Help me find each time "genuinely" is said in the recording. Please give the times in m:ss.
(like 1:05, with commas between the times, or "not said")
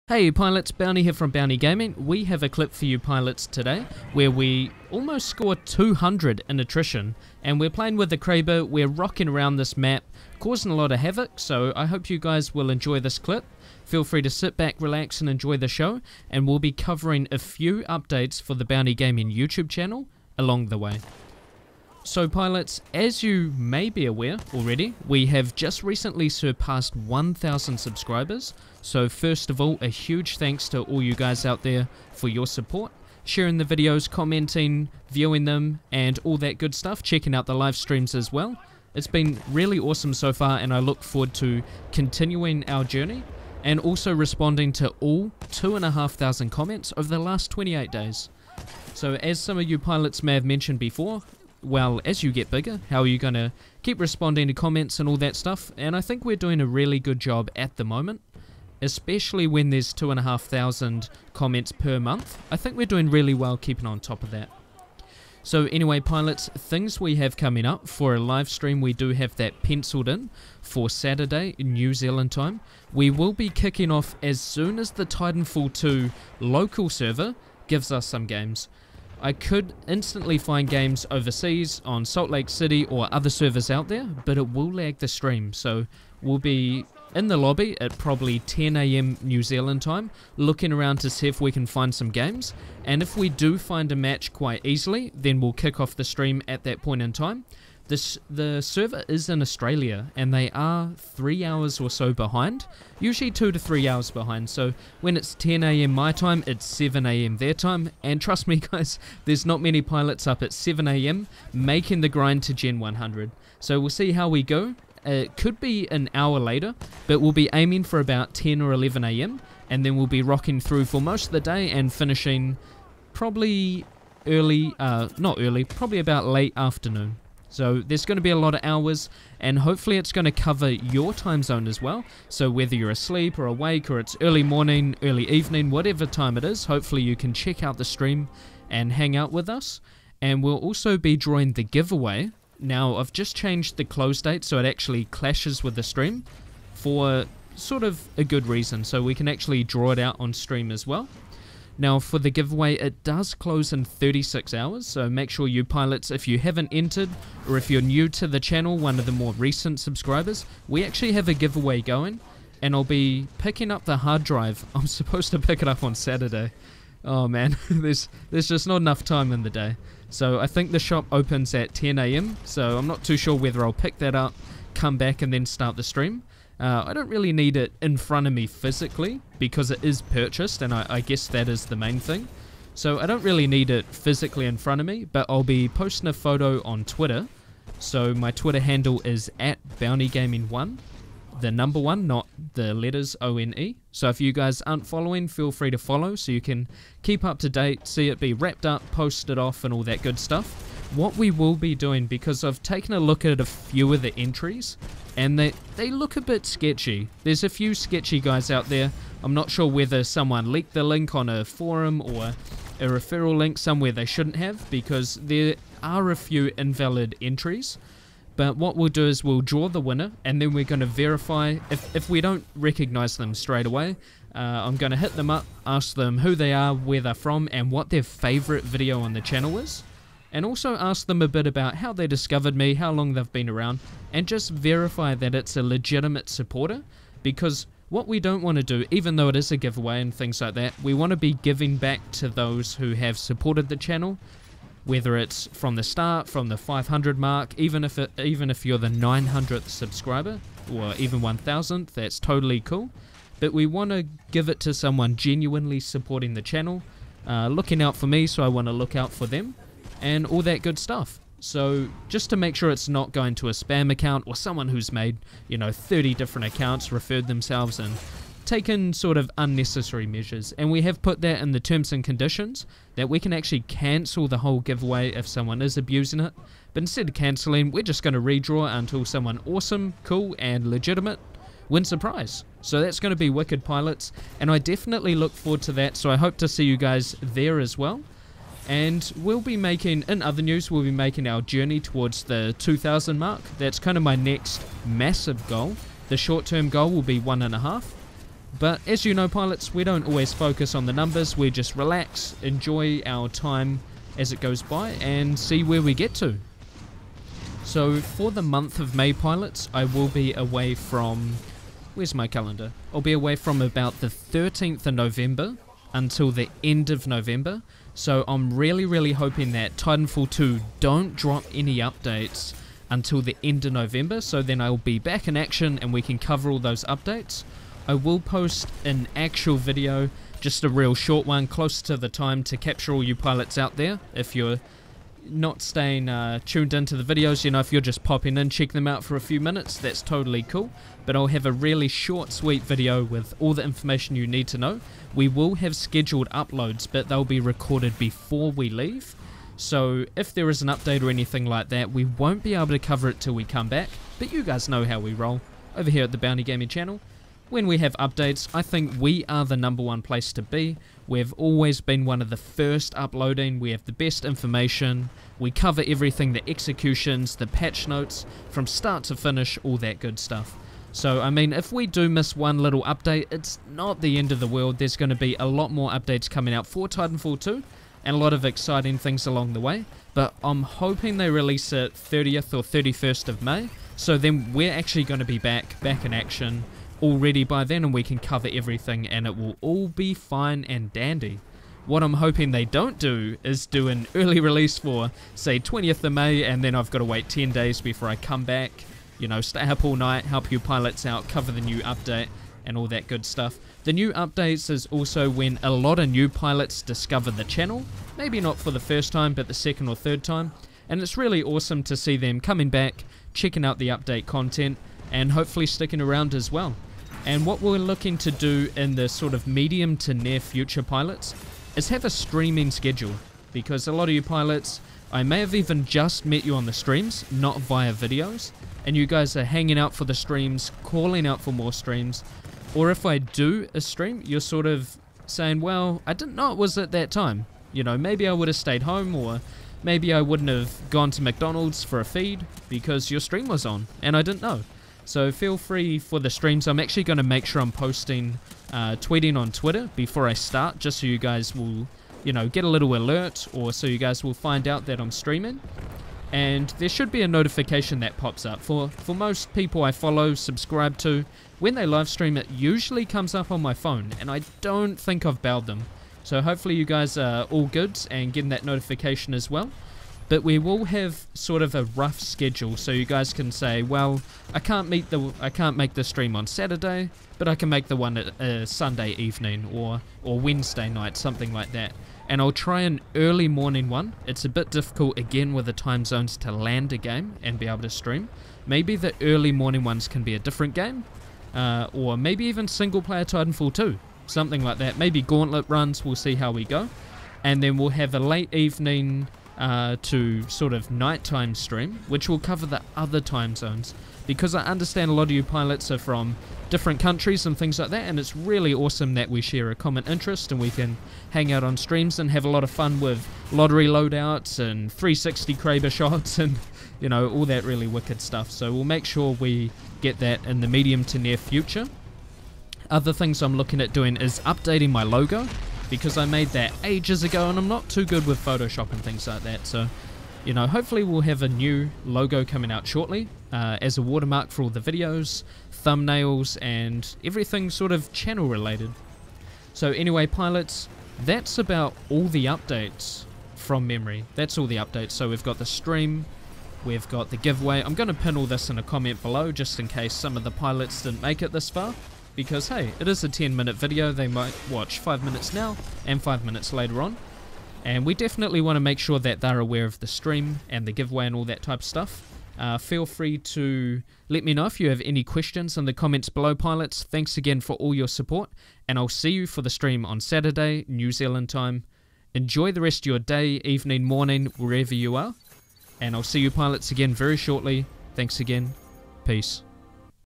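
4:15.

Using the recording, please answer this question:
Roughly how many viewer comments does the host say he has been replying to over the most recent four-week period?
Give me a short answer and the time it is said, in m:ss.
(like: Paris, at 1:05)
2,500, at 0:45.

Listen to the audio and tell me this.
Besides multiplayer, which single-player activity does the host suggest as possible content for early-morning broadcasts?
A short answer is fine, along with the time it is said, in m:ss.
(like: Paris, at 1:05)
Gauntlet runs, at 8:15.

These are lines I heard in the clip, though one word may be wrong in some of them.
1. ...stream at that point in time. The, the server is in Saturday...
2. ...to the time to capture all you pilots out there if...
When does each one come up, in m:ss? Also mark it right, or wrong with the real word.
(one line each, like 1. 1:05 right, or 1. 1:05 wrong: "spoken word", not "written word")
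1. 1:36 wrong: "Australia", not "Saturday"
2. 5:31 right.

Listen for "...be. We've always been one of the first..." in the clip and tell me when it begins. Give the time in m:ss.
6:00.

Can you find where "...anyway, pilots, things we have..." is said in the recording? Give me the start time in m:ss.
1:05.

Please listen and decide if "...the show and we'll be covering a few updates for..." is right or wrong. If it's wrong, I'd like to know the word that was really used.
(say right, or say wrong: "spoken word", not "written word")
right.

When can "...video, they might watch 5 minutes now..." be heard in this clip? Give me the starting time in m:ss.
9:13.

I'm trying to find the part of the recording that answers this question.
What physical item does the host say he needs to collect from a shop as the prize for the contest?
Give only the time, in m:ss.
2:43.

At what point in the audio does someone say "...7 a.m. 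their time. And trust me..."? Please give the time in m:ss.
1:46.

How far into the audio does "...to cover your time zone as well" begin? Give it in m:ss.
2:10.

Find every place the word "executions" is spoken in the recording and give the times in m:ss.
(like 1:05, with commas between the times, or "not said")
6:06.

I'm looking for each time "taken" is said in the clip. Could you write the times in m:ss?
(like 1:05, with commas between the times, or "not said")
3:22, 4:28.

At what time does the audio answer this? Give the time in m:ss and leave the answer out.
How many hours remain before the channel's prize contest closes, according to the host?
2:33.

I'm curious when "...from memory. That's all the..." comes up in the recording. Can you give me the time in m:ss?
9:03.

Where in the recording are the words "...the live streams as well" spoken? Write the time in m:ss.
0:37.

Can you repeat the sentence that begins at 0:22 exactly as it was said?
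So pilots, as you may be aware already, we have just recently surpassed 1,000 subscribers.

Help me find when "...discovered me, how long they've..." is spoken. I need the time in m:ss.
3:52.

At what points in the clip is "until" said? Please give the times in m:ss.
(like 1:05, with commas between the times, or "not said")
4:38, 5:15, 5:22.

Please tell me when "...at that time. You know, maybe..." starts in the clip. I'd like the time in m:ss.
7:16.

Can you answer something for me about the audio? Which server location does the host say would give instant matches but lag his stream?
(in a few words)
Salt Lake City.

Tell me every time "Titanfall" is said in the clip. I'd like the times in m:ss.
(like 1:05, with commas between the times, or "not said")
1:15, 5:19, 6:16, 8:13.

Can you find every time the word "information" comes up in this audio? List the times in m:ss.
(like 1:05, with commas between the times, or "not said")
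5:43, 6:04.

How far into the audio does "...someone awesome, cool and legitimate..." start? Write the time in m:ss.
4:39.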